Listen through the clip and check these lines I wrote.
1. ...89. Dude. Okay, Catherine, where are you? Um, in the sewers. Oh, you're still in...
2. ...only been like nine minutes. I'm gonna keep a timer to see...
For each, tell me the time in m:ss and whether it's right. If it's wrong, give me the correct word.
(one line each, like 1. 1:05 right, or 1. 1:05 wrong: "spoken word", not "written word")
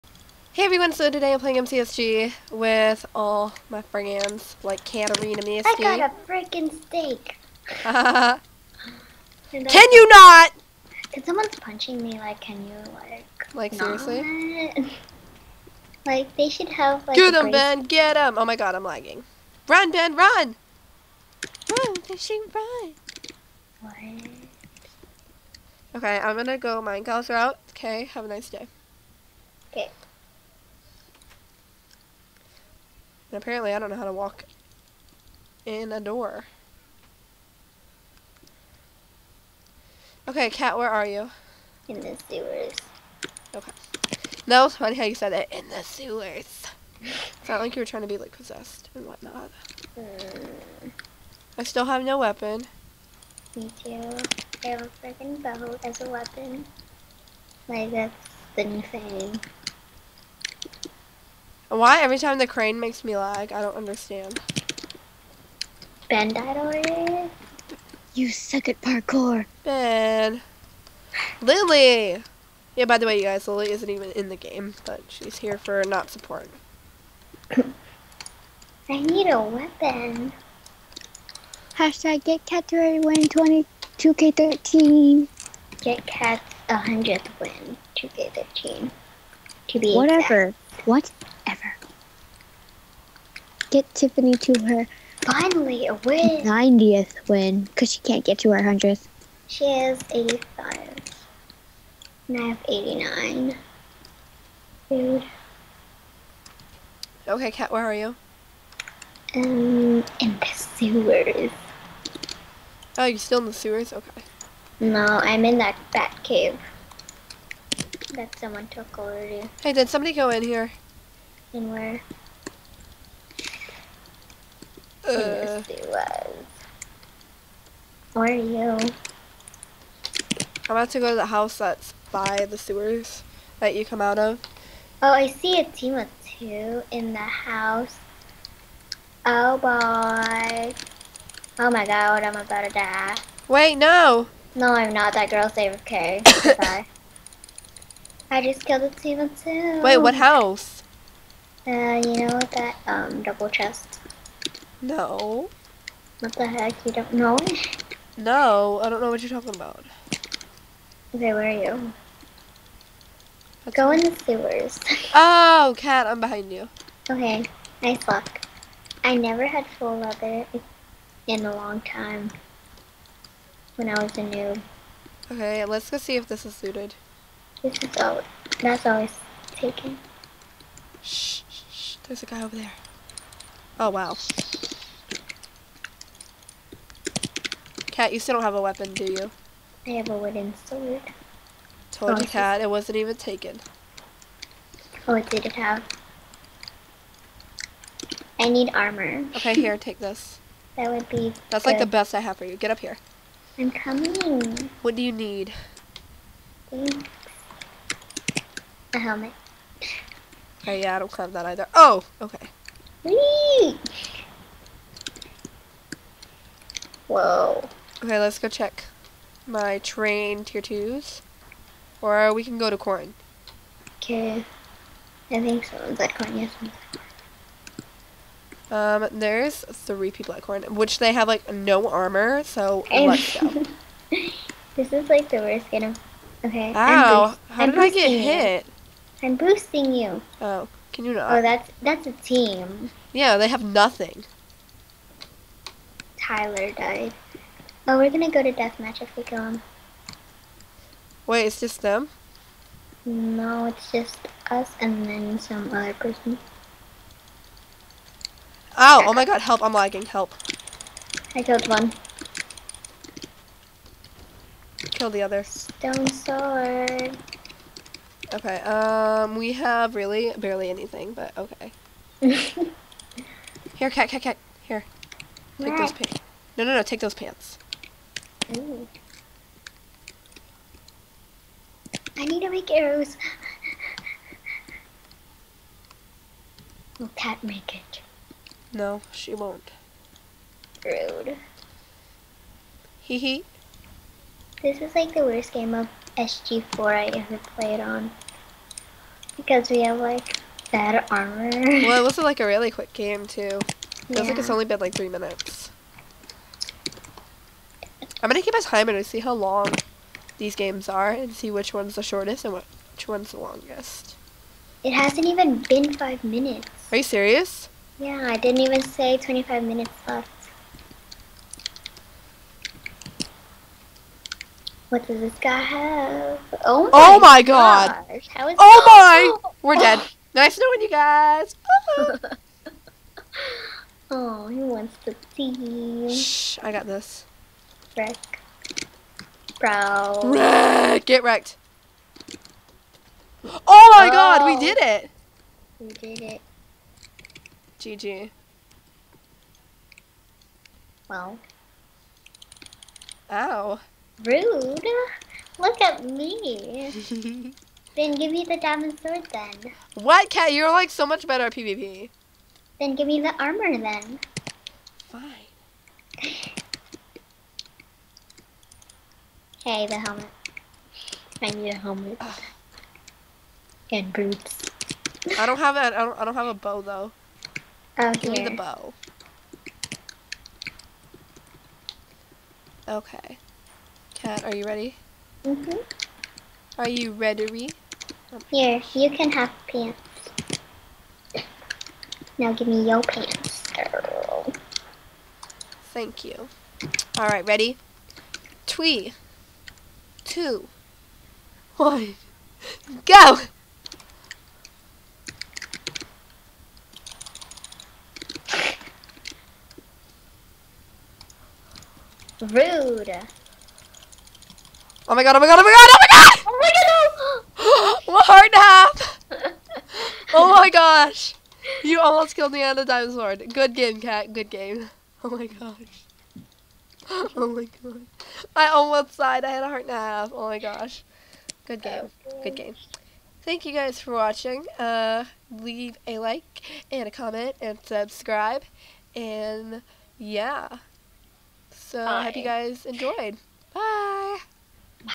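1. 1:42 wrong: "Kat", not "Catherine"
2. 5:04 wrong: "three", not "nine".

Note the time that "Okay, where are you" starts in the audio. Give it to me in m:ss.
2:41.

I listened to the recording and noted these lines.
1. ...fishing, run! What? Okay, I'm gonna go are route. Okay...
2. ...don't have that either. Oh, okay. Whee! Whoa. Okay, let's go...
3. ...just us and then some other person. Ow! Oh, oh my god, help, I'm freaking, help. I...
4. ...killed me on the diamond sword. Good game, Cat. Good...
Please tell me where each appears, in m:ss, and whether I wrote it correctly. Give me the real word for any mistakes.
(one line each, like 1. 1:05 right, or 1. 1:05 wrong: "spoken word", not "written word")
1. 0:22 right
2. 3:30 right
3. 4:13 wrong: "lagging", not "freaking"
4. 7:02 right.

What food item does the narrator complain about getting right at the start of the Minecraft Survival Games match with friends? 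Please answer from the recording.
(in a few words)
Steak.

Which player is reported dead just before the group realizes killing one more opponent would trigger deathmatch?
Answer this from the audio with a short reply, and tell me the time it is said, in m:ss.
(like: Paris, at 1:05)
Tyler, at 4:06.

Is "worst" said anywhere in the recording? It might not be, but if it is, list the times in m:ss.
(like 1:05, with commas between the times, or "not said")
3:55, 4:55.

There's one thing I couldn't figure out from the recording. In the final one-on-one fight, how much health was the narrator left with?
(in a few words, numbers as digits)
A heart and a half.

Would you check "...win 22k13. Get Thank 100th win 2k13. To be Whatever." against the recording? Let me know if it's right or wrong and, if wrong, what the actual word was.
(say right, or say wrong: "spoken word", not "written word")
wrong: "Cat", not "Thank".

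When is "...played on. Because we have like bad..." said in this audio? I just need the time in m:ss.
4:57.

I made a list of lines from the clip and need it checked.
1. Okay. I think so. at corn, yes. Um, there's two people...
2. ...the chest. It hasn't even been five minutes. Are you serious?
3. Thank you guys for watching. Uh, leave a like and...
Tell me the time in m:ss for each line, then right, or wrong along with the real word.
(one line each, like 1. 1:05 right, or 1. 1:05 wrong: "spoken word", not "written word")
1. 3:43 wrong: "three", not "two"
2. 5:13 wrong: "longest", not "chest"
3. 7:13 right.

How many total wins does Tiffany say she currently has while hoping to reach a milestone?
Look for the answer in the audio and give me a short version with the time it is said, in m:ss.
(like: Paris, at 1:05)
85, at 1:39.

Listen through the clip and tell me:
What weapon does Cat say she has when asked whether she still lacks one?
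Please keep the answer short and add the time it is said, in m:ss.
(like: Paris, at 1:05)
Wooden sword, at 3:10.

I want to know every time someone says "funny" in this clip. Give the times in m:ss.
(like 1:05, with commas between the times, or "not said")
0:44.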